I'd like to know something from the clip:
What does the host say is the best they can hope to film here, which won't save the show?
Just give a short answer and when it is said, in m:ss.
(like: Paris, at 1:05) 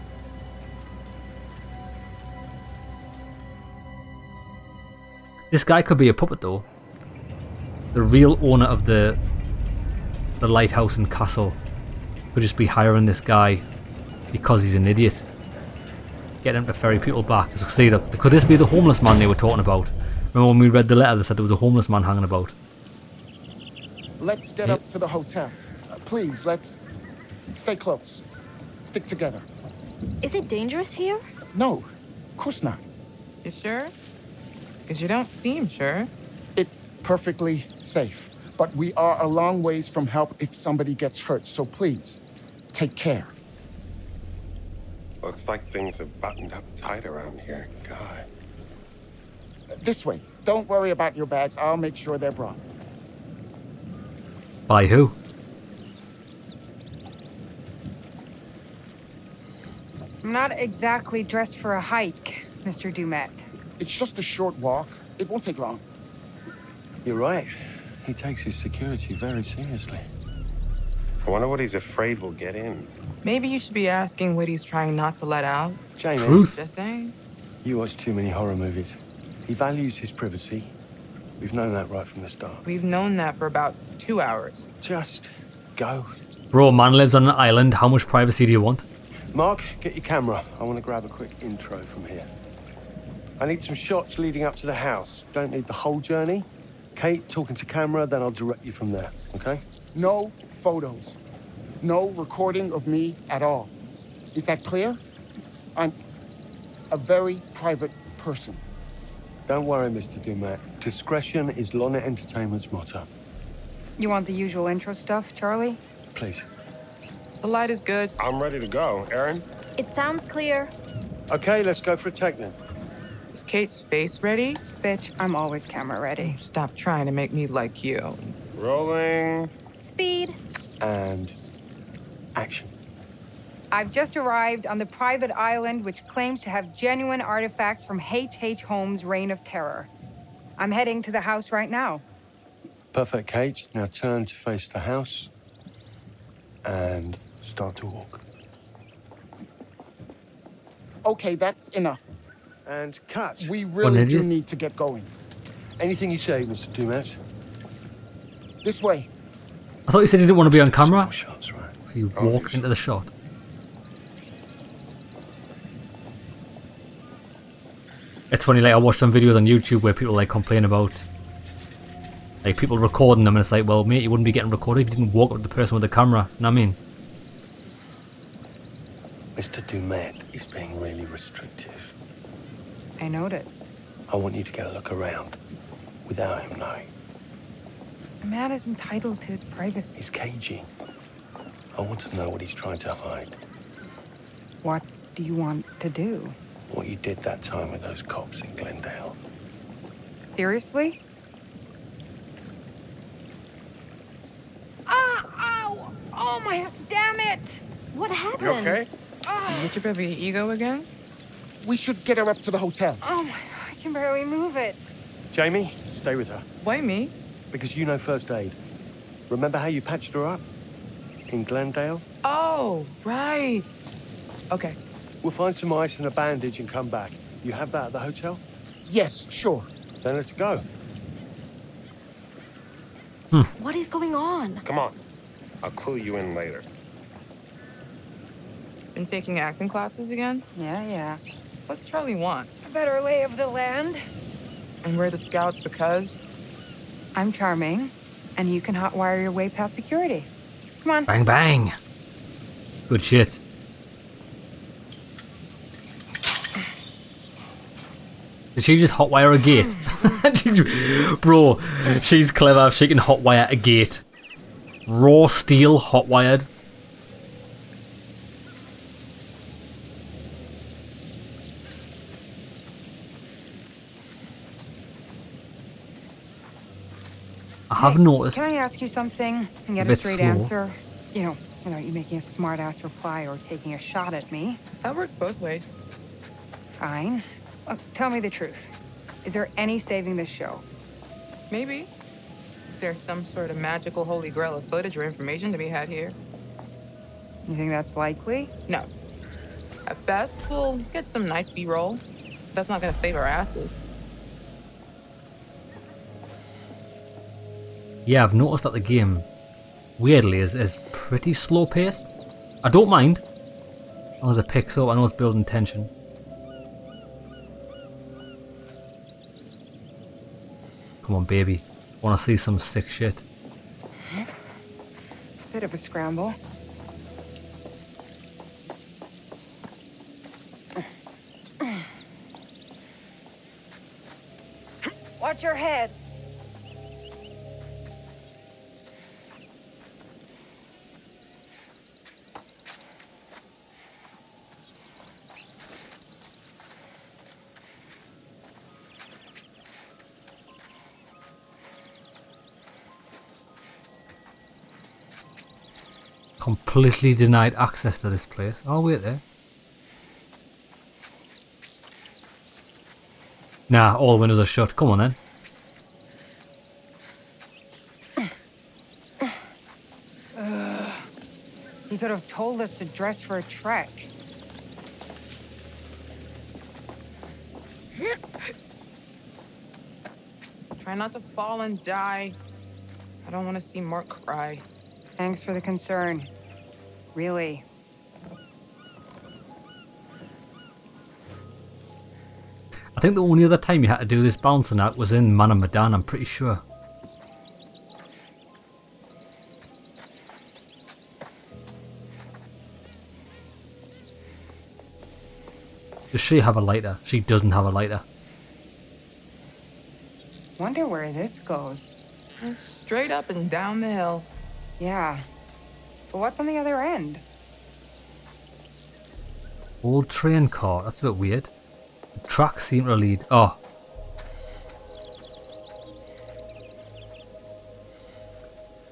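B-roll, at 5:01.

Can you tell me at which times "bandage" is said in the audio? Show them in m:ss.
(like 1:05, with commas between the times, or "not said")
3:46.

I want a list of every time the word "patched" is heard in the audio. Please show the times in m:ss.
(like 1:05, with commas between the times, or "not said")
3:39.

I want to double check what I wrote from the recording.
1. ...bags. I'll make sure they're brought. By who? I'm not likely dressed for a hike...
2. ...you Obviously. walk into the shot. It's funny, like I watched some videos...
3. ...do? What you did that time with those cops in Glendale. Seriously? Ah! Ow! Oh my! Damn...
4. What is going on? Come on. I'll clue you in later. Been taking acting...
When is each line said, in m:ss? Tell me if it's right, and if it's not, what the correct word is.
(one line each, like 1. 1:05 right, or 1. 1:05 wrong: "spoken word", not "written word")
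1. 0:51 wrong: "exactly", not "likely"
2. 2:41 right
3. 3:15 right
4. 3:53 right.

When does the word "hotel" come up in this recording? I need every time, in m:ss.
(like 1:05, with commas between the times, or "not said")
0:25, 3:32, 3:47.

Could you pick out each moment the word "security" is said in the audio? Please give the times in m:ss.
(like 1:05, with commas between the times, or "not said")
1:08, 4:09.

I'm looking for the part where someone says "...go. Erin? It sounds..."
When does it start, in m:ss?
1:58.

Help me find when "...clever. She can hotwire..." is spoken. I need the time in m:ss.
4:22.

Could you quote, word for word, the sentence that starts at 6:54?
Yeah, but what's on the other end?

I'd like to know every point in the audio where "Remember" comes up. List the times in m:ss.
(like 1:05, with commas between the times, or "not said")
0:20, 3:39.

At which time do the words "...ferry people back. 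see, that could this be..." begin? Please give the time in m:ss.
0:16.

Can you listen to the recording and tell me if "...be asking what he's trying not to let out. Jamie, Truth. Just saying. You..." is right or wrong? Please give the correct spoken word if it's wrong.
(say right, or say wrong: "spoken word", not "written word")
right.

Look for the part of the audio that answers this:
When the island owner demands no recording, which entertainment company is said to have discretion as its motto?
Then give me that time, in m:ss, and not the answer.
1:51.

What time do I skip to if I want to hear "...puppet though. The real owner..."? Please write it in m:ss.
0:06.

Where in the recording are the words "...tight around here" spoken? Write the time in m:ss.
0:46.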